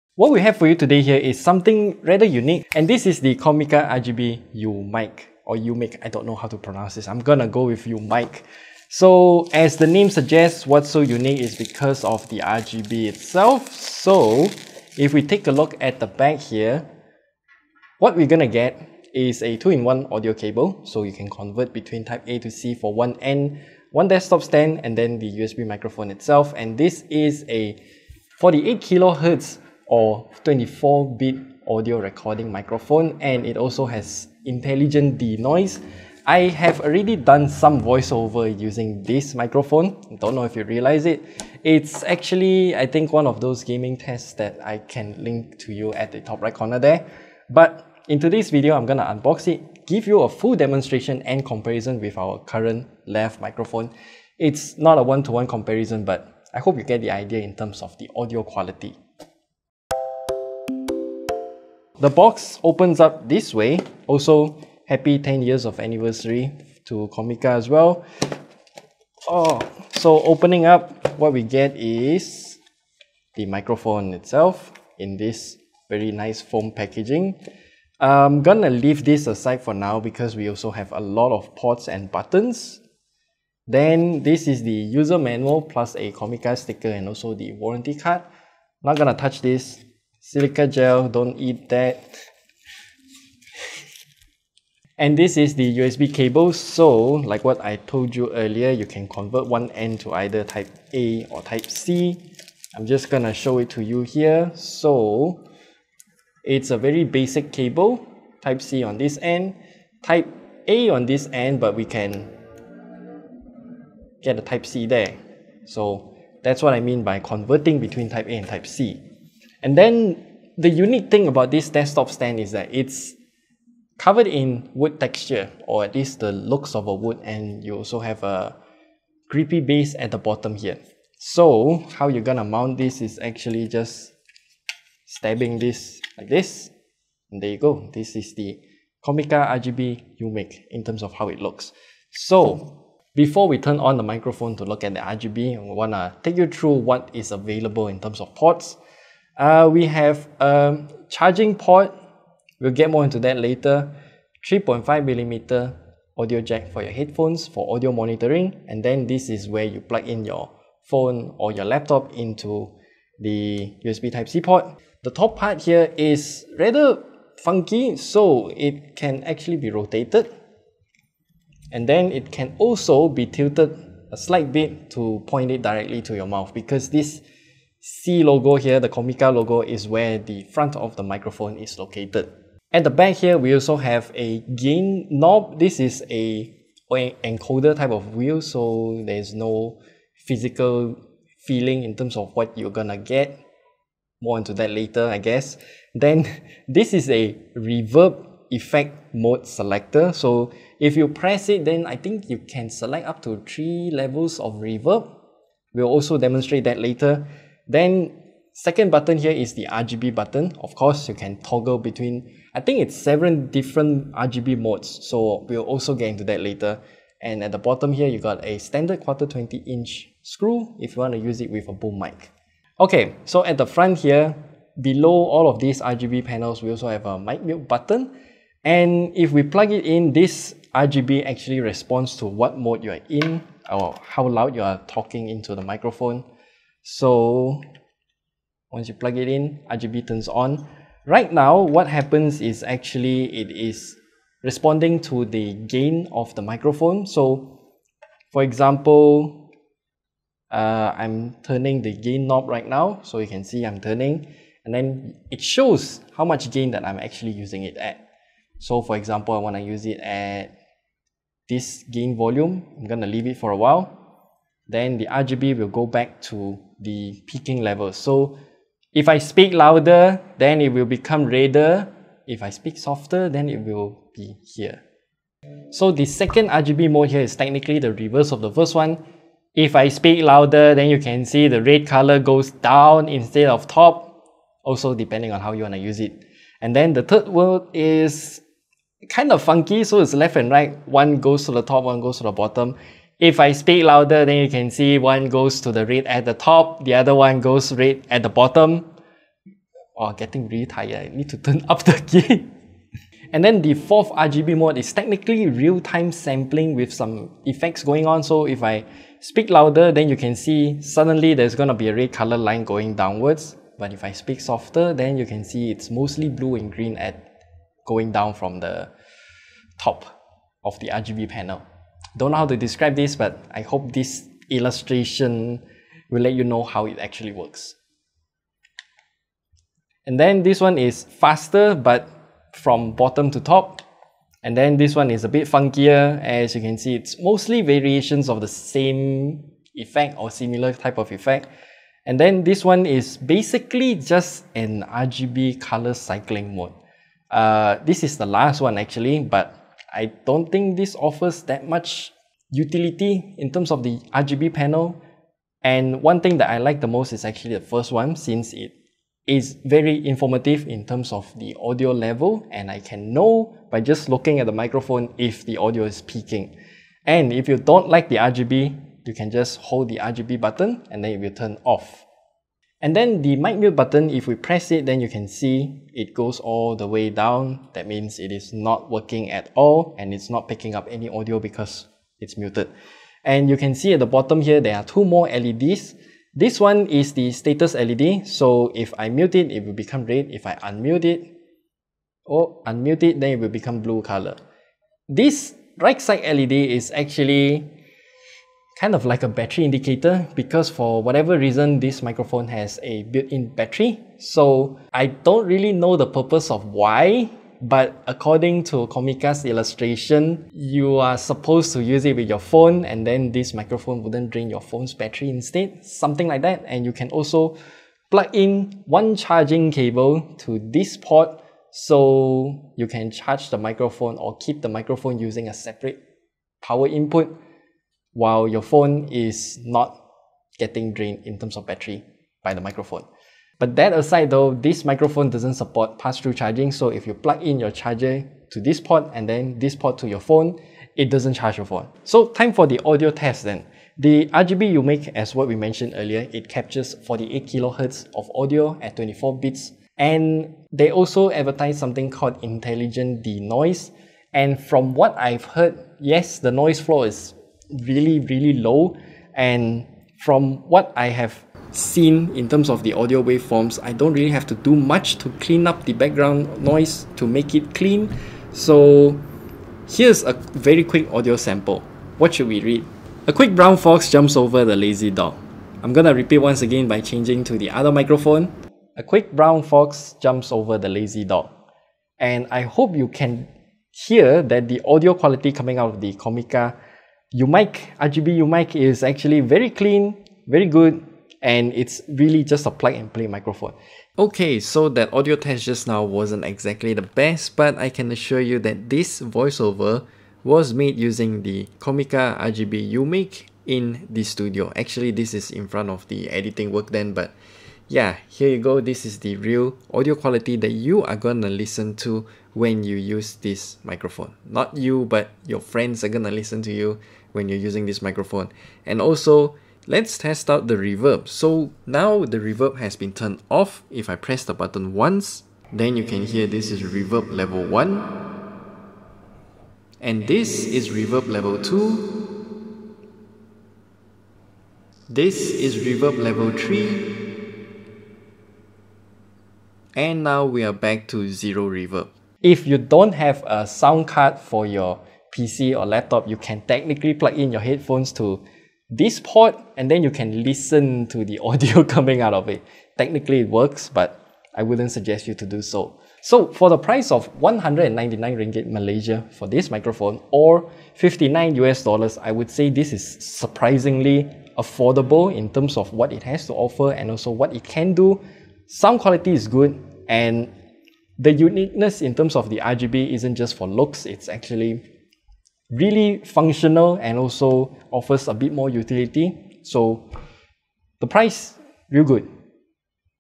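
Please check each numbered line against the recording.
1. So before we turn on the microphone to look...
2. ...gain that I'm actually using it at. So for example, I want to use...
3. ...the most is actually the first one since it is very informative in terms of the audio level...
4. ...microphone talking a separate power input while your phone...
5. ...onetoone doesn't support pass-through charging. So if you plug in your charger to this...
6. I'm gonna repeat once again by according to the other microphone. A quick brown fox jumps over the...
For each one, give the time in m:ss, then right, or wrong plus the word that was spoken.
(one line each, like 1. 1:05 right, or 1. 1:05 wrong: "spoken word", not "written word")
1. 2:22 right
2. 4:16 right
3. 5:56 right
4. 7:04 wrong: "using", not "talking"
5. 7:14 wrong: "microphone", not "onetoone"
6. 7:55 wrong: "changing", not "according".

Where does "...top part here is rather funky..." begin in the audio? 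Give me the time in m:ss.
2:45.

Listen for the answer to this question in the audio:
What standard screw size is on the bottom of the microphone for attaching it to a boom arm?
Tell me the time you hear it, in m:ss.
3:38.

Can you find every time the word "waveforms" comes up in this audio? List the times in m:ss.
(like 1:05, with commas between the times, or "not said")
7:43.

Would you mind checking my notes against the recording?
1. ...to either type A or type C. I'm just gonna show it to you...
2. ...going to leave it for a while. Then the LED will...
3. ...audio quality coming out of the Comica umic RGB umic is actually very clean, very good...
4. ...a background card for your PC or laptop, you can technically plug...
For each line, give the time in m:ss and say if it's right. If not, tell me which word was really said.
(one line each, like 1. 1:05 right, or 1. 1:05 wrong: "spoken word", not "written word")
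1. 1:40 right
2. 4:22 wrong: "RGB", not "LED"
3. 8:04 right
4. 9:03 wrong: "sound", not "background".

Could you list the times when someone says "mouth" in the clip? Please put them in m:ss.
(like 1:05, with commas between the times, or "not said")
2:56.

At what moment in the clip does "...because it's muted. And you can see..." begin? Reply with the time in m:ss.
6:21.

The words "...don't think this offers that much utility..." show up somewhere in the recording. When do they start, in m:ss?
5:50.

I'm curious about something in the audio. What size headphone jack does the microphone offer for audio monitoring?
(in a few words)
3.5 millimeter.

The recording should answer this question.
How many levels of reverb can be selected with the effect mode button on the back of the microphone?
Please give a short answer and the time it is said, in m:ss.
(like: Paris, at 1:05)
3, at 3:23.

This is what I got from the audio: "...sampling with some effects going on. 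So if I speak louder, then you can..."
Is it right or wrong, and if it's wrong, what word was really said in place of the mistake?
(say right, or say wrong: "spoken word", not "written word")
right.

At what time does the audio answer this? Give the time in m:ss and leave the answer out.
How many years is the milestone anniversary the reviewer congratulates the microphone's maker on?
1:05.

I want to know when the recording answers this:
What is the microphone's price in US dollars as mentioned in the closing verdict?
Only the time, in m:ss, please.
9:20.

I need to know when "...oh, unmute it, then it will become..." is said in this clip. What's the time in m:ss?
6:32.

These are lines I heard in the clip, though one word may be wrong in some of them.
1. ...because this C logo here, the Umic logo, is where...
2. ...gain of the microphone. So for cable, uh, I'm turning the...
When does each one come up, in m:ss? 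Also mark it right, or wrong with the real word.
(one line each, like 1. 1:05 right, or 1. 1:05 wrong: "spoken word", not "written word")
1. 2:56 wrong: "Comica", not "Umic"
2. 4:05 wrong: "example", not "cable".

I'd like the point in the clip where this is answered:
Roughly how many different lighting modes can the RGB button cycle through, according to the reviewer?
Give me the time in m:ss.
3:32.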